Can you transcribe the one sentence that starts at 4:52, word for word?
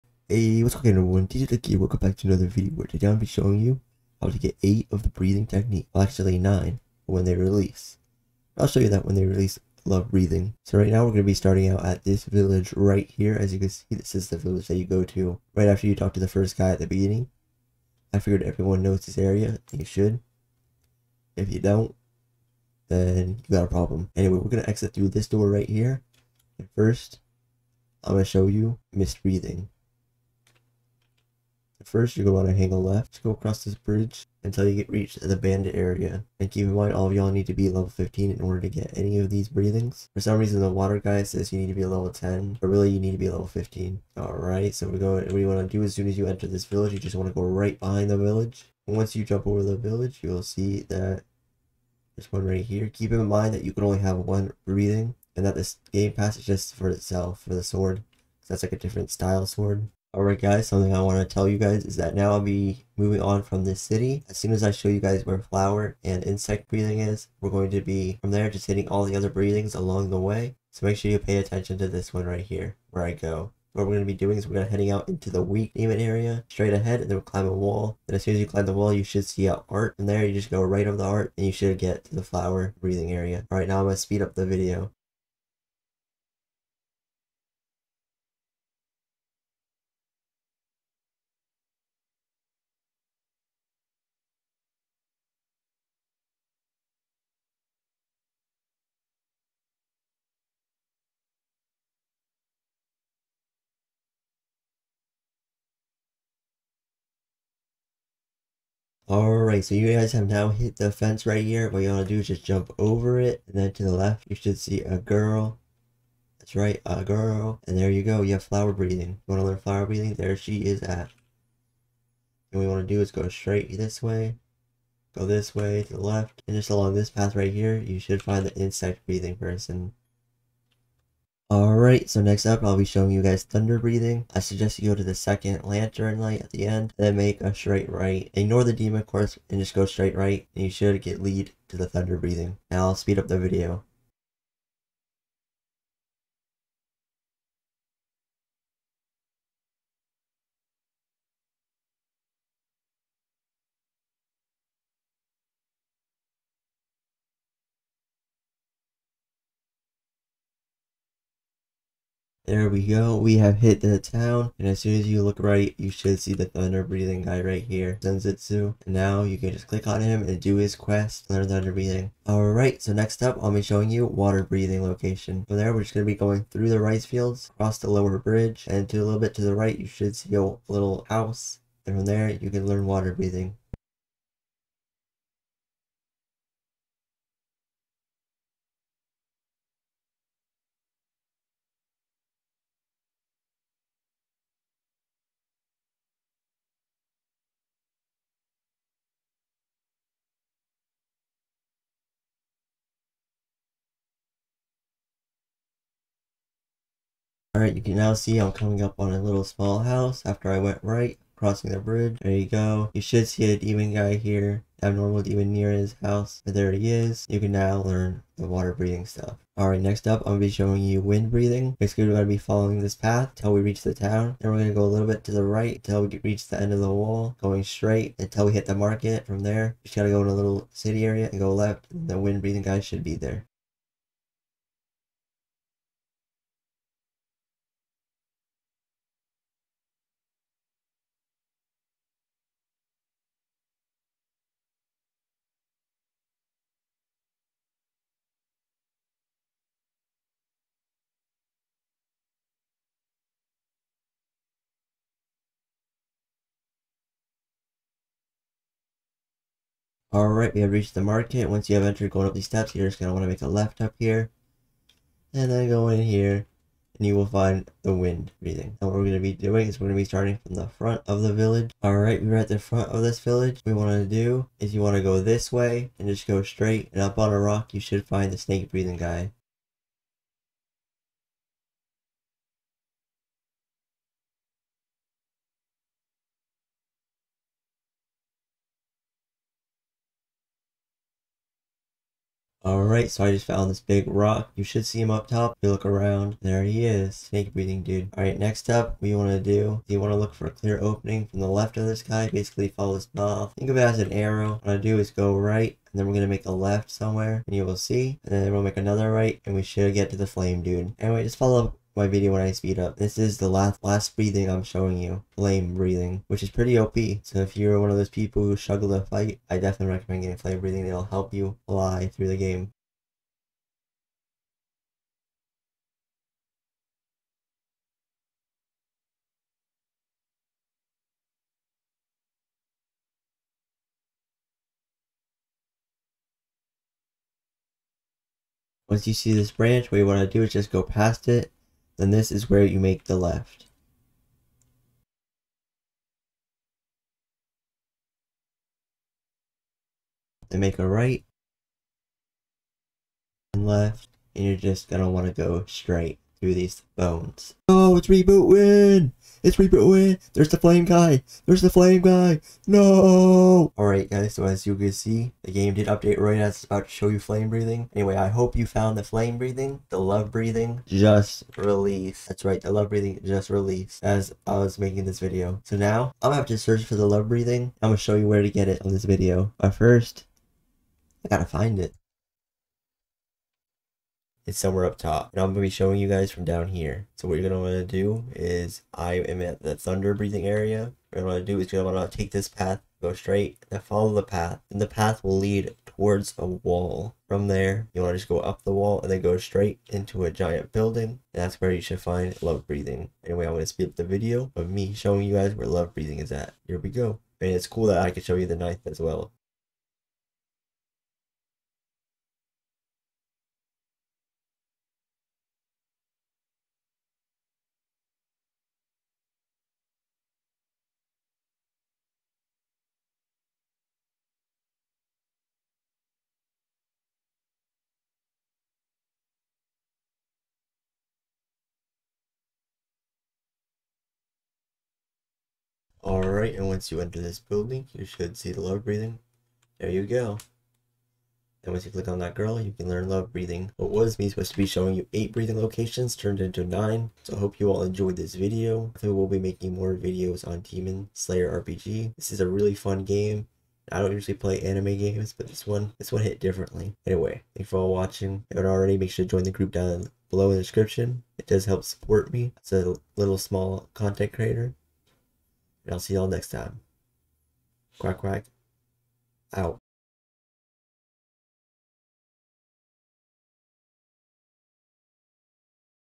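Alright, so I just found this big rock.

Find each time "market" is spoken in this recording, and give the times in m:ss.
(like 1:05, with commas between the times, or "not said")
3:48, 4:20.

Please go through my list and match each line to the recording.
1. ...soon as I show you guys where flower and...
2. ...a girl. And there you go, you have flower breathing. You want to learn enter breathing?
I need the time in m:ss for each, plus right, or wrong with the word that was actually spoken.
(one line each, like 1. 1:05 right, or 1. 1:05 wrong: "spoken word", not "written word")
1. 1:04 right
2. 1:56 wrong: "flower", not "enter".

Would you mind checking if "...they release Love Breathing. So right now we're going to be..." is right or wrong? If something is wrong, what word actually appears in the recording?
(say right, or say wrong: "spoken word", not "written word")
right.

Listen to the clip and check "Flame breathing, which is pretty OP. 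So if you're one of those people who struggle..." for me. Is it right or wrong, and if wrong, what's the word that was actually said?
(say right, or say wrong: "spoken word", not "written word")
right.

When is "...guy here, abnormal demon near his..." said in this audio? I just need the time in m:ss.
3:33.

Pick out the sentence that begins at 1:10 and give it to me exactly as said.
So make sure you pay attention to this one right here, where I go.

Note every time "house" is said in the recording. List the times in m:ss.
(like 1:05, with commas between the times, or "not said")
3:01, 3:29, 3:36.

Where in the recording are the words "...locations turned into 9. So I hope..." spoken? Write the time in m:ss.
7:25.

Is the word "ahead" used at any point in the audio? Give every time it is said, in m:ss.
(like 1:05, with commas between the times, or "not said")
1:16.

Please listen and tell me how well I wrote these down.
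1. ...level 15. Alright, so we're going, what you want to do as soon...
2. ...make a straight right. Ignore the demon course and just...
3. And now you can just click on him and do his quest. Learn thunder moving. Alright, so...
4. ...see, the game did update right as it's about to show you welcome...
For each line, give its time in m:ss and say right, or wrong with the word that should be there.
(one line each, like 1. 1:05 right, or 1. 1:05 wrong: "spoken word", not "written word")
1. 0:43 right
2. 2:17 right
3. 2:48 wrong: "breathing", not "moving"
4. 6:04 wrong: "flame", not "welcome".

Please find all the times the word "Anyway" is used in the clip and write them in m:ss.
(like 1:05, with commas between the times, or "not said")
0:24, 5:10, 6:07, 6:43, 7:37.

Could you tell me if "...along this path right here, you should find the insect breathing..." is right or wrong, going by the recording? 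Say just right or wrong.
right.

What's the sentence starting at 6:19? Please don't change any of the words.
But first, I gotta find it it's somewhere up top.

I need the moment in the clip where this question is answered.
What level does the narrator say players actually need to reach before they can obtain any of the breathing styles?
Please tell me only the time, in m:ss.
0:37.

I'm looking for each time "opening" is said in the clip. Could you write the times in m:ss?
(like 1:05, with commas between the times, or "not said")
5:00.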